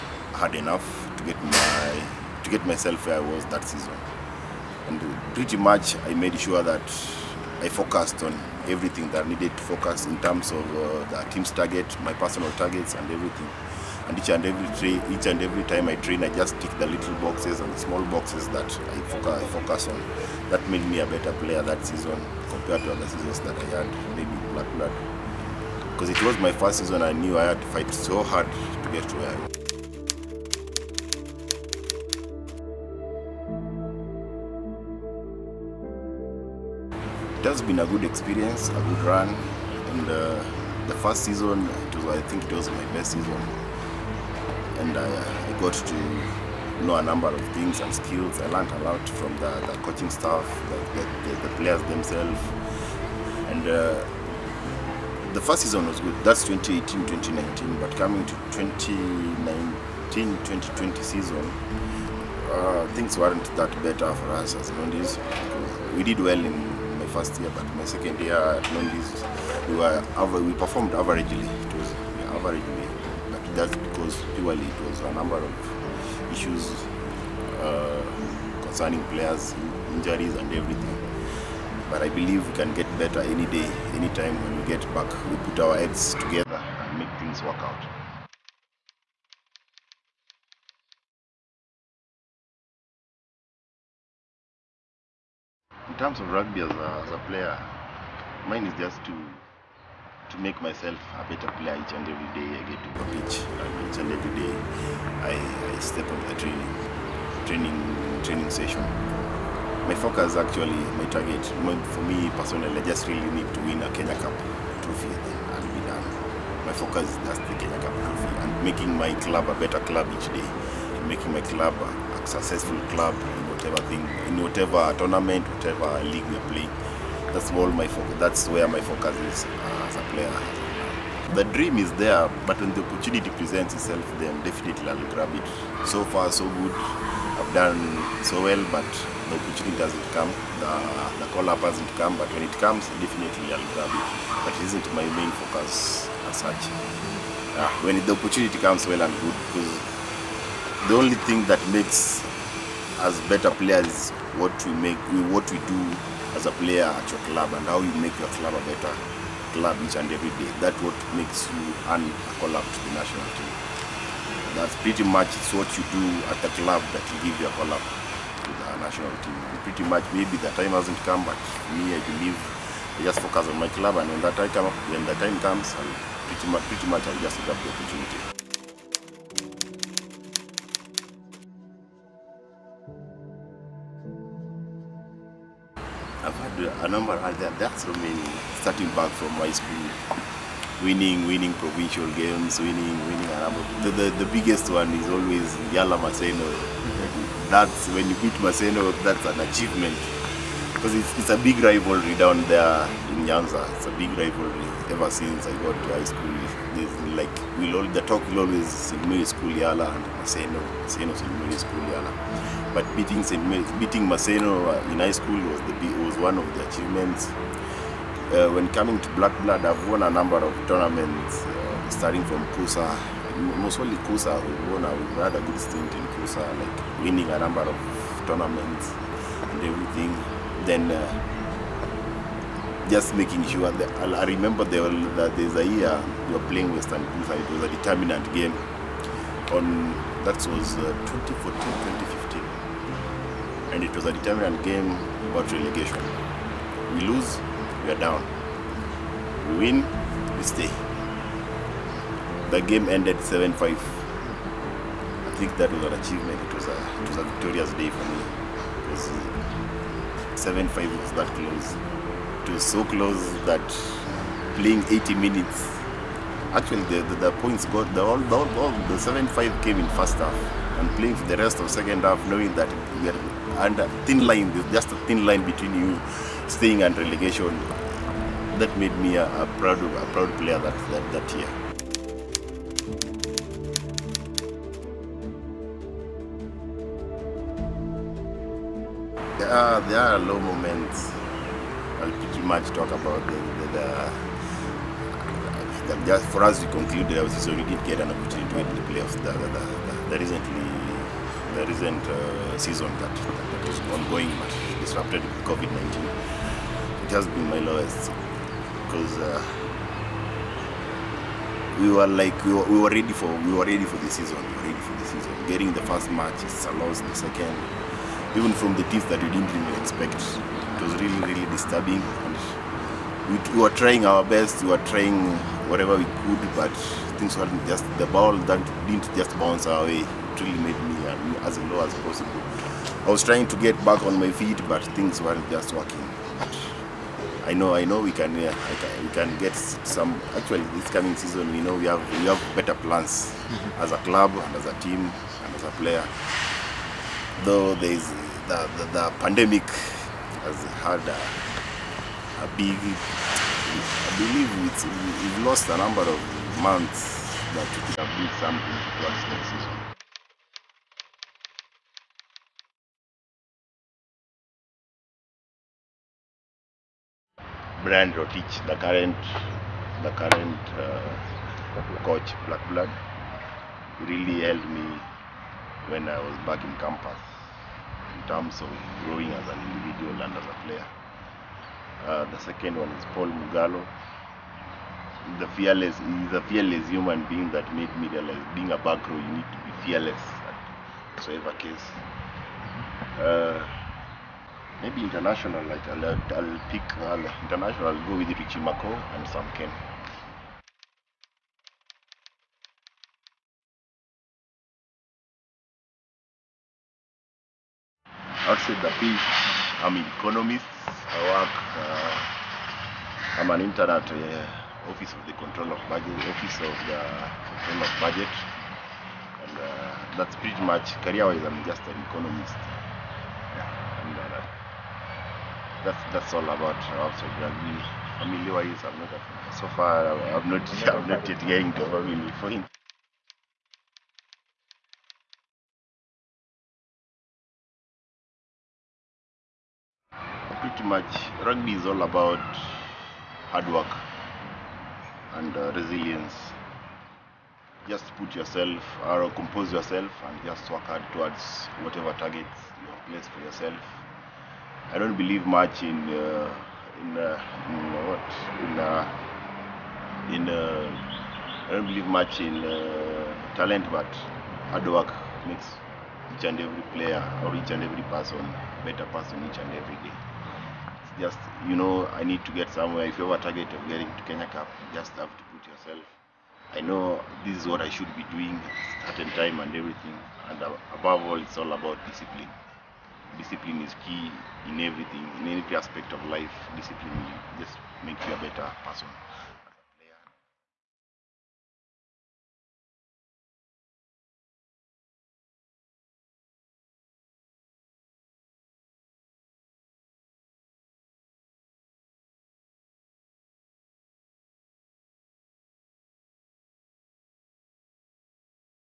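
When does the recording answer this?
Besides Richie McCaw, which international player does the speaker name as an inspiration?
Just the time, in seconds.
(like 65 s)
399 s.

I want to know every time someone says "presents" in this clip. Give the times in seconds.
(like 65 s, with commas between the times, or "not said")
133 s.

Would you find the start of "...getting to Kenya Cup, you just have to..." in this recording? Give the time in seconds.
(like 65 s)
473 s.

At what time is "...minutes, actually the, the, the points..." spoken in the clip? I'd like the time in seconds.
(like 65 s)
265 s.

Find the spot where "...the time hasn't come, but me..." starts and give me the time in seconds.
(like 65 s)
170 s.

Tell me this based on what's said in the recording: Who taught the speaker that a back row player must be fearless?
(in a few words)
Paul Mugalo.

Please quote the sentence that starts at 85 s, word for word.
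We put our heads together and make things work out.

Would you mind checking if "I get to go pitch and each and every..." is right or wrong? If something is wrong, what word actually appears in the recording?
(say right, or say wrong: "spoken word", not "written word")
right.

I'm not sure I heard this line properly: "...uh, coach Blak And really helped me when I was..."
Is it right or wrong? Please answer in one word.
wrong.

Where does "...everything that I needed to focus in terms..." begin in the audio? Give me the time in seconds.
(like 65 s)
8 s.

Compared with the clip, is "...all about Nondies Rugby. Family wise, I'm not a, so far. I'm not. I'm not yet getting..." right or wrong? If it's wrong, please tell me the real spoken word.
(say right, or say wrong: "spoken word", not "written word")
wrong: "Robson", not "Nondies".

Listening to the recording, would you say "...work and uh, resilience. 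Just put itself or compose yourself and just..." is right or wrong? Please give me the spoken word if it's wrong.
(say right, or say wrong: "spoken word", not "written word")
wrong: "yourself", not "itself".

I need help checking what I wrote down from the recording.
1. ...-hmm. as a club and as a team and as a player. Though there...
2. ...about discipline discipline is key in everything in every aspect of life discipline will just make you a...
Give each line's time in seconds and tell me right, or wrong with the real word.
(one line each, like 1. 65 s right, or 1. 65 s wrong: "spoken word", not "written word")
1. 343 s right
2. 481 s right.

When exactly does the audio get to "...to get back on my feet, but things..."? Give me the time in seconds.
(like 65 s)
333 s.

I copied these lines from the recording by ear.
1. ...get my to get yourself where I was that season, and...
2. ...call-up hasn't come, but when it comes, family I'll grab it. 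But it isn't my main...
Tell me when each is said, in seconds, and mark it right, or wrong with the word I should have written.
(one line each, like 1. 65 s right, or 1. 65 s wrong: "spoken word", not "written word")
1. 1 s wrong: "myself", not "yourself"
2. 141 s wrong: "definitely", not "family".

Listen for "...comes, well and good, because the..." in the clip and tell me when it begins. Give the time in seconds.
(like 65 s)
148 s.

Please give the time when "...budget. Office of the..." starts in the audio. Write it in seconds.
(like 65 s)
415 s.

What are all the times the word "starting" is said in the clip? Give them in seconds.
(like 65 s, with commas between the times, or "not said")
188 s, 221 s.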